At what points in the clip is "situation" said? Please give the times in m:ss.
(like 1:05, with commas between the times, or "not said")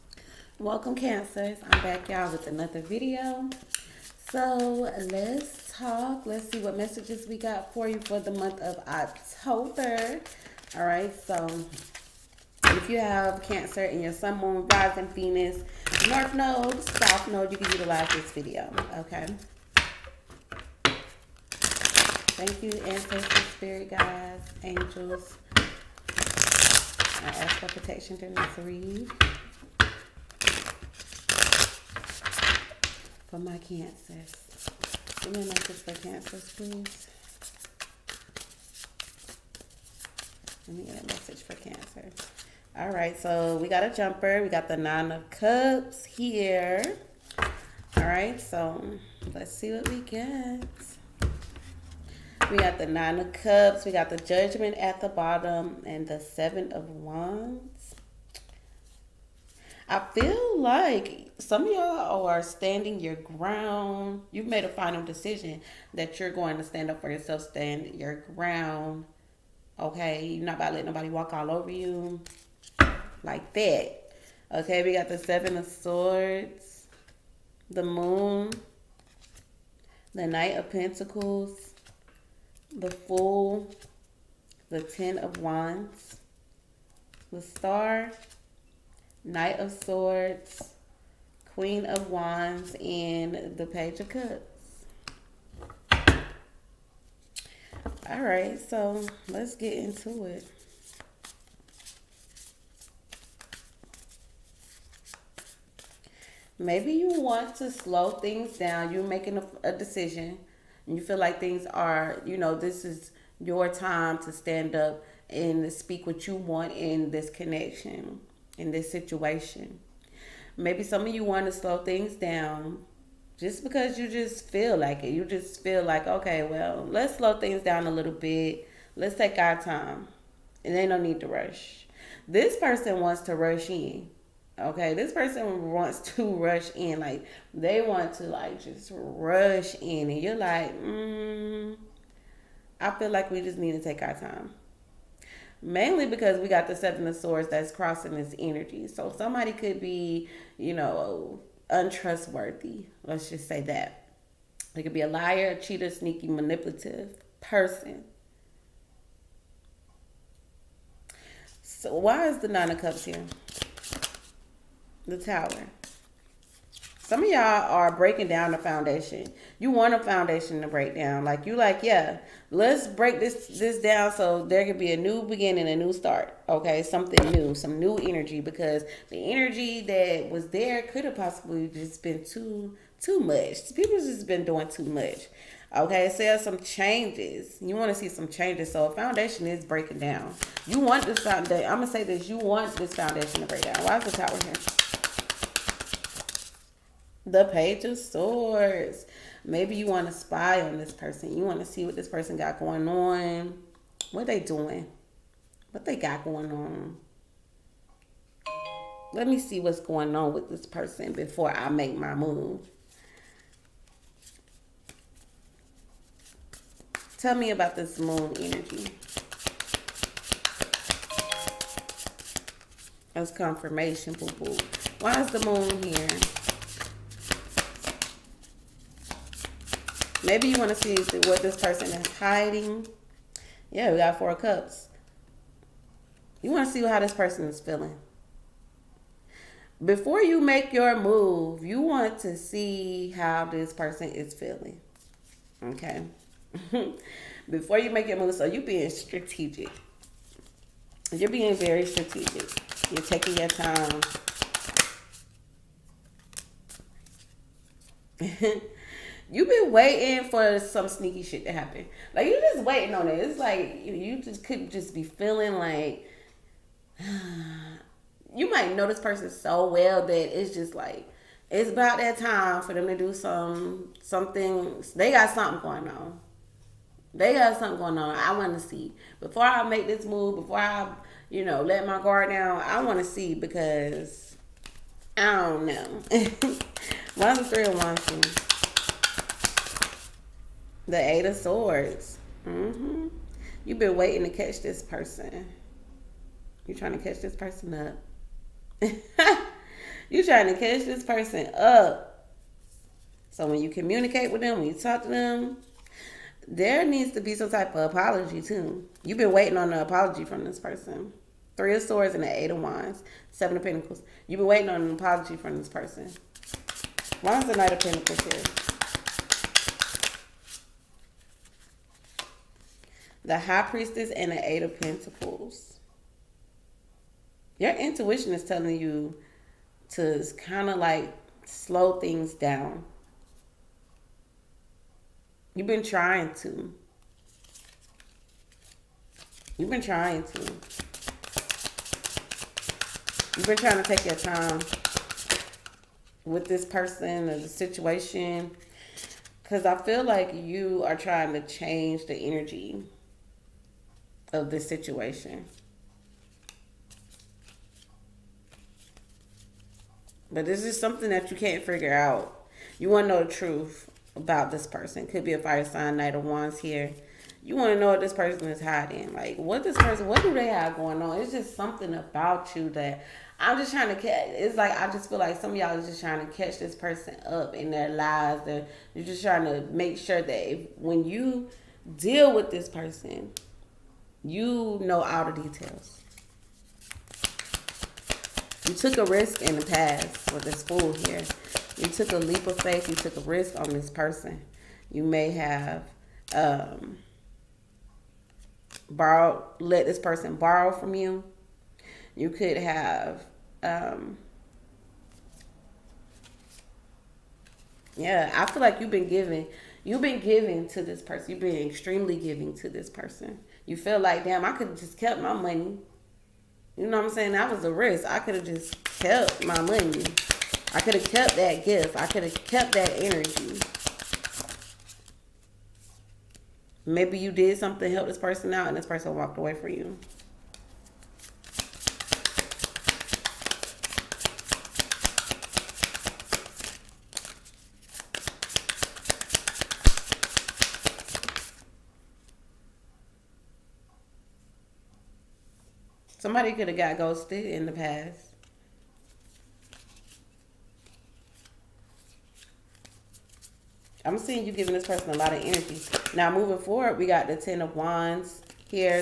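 1:58, 5:47, 5:54.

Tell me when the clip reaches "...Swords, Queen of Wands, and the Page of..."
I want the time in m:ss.
1:29.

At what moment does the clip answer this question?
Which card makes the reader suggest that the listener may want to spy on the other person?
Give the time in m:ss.
3:17.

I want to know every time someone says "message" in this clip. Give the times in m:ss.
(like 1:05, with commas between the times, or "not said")
0:06, 0:35, 0:41.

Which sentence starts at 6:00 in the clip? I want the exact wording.
But this is something that you can't figure out.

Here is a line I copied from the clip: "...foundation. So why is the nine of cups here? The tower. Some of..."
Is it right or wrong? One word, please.
wrong.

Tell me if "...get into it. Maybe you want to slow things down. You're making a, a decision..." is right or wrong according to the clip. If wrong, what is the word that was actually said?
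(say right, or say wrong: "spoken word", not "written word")
right.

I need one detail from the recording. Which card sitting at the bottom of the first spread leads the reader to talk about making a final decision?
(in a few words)
Judgment.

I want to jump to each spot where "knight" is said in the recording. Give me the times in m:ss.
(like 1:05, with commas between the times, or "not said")
1:20, 1:29, 5:17, 6:05.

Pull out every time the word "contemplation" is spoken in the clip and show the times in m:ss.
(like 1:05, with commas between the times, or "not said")
not said.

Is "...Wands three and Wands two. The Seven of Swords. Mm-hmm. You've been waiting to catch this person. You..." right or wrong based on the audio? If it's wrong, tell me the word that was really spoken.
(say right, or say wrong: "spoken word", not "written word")
wrong: "Eight", not "Seven".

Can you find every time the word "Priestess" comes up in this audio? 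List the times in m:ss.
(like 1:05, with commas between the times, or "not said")
5:23.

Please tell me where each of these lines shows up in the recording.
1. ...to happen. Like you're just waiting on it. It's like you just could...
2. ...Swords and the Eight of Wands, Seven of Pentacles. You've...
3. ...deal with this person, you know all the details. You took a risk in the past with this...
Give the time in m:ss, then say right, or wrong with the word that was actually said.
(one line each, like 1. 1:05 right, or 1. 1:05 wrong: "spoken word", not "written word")
1. 4:21 right
2. 5:11 right
3. 6:21 right.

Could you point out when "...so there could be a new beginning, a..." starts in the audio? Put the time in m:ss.
2:54.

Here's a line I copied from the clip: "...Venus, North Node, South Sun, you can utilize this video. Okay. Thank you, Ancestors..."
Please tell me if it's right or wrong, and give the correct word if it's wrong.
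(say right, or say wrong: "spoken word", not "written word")
wrong: "Node", not "Sun".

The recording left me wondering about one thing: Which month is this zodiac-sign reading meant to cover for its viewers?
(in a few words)
October.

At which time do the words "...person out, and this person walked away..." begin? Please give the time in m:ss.
7:08.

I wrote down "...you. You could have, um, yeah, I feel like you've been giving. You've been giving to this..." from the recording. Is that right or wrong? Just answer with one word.
right.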